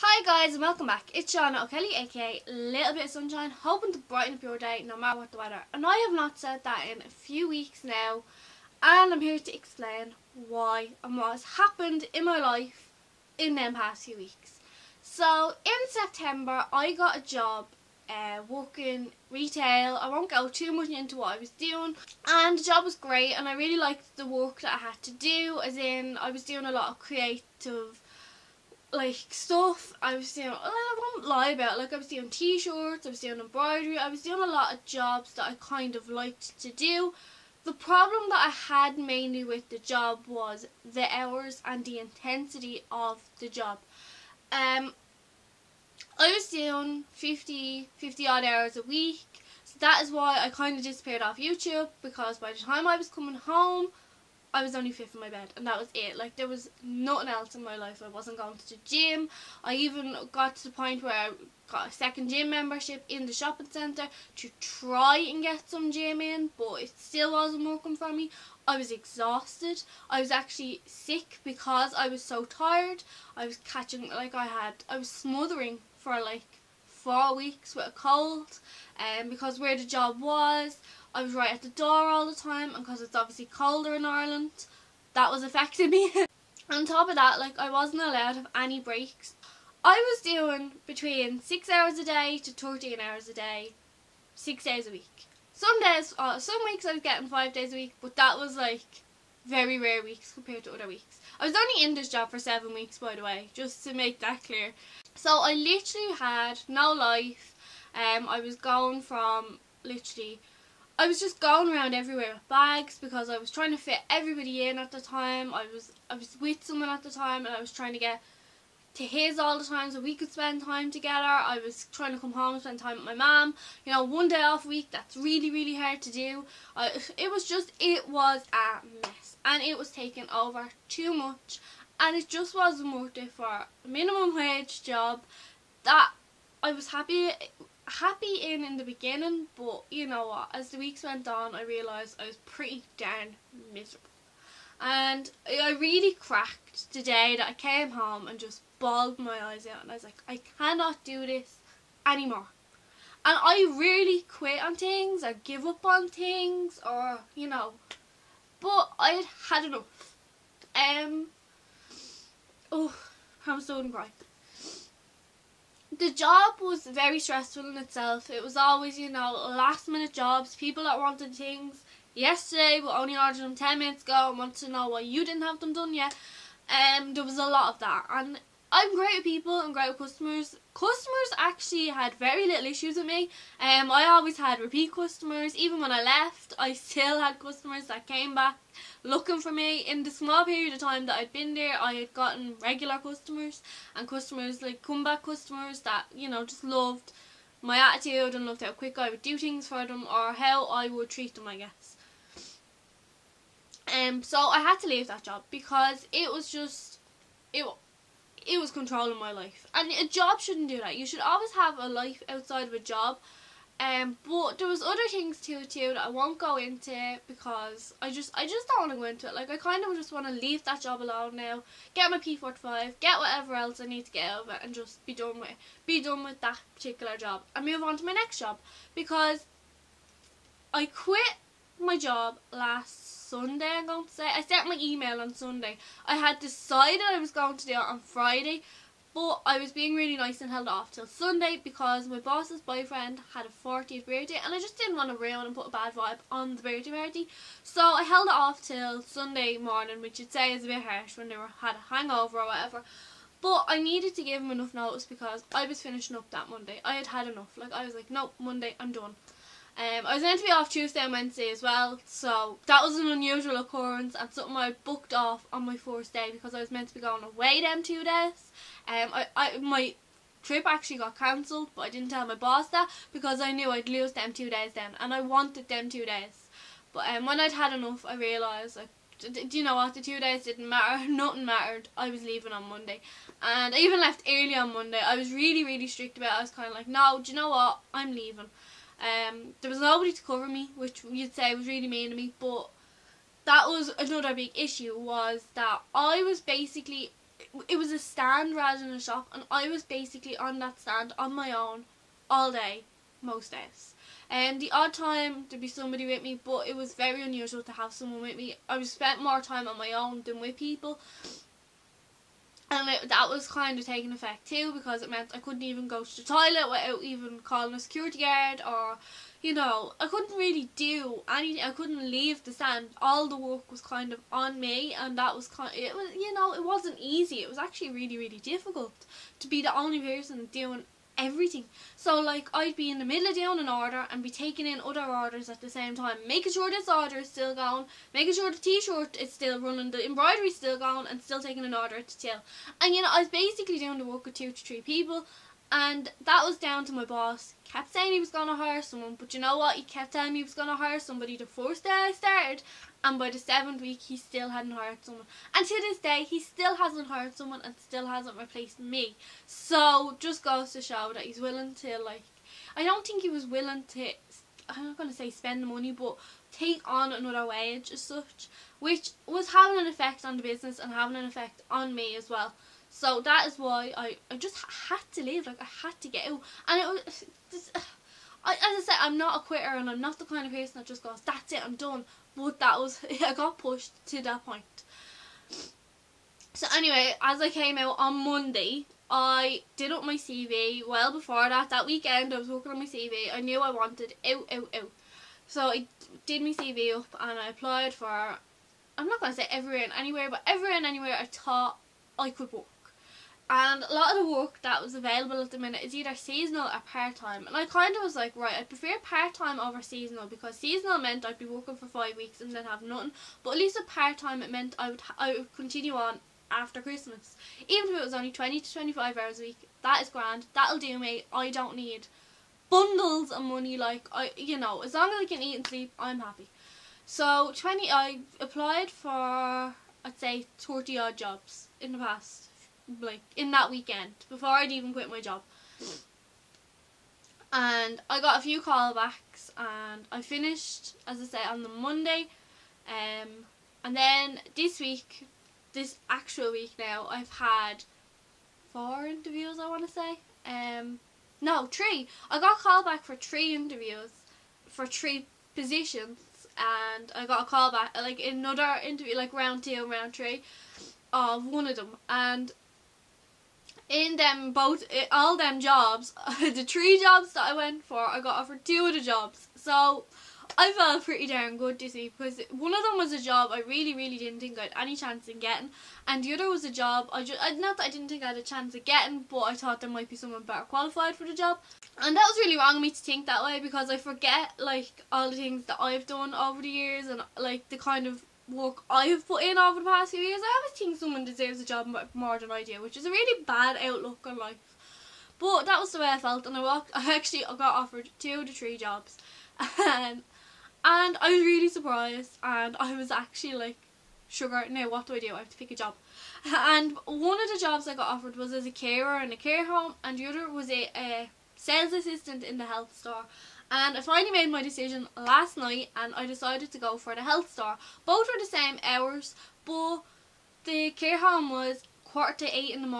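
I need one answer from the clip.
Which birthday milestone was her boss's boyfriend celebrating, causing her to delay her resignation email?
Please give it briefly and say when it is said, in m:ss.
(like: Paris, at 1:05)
40th, at 4:03.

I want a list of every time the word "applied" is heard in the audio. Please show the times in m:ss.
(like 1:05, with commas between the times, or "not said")
6:37, 7:08.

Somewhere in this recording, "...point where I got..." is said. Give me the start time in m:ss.
1:00.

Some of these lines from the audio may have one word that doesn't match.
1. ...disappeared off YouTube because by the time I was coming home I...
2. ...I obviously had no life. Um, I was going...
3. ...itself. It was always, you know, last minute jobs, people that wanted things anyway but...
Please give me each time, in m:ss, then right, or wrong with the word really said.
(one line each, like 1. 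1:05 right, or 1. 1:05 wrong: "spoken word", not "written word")
1. 0:50 right
2. 1:45 wrong: "literally", not "obviously"
3. 2:47 wrong: "yesterday", not "anyway".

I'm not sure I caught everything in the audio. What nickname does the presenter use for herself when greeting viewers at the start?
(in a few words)
Little Bit of Sunshine.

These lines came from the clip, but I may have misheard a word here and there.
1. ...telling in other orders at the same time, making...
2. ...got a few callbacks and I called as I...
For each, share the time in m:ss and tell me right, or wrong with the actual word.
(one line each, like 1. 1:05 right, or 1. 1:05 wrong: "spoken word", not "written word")
1. 5:34 wrong: "taking", not "telling"
2. 7:18 wrong: "finished", not "called".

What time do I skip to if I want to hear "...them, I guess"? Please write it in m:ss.
3:21.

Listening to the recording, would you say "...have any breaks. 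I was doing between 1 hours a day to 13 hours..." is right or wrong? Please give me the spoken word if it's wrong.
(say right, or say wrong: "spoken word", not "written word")
wrong: "6", not "1".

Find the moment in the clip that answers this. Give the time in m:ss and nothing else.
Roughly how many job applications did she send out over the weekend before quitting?
7:10.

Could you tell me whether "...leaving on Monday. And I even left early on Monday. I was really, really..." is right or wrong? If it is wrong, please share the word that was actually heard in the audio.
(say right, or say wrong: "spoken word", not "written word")
right.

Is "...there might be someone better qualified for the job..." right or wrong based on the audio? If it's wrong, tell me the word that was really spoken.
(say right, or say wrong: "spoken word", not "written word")
right.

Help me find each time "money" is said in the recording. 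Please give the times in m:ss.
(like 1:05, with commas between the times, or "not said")
6:05, 7:03.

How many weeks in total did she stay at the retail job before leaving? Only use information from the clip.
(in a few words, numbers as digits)
7.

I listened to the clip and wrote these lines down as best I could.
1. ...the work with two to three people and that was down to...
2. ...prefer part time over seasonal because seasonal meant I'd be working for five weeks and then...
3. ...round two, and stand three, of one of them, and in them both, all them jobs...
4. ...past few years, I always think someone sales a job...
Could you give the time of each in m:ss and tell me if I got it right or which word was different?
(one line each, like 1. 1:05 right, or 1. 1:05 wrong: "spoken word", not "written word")
1. 5:43 right
2. 6:48 right
3. 7:39 wrong: "round", not "stand"
4. 8:09 wrong: "deserves", not "sales".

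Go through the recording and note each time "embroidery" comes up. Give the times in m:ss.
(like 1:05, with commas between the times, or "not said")
0:33, 5:40.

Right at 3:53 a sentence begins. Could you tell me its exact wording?
I'm going to say I sent my email on Sunday.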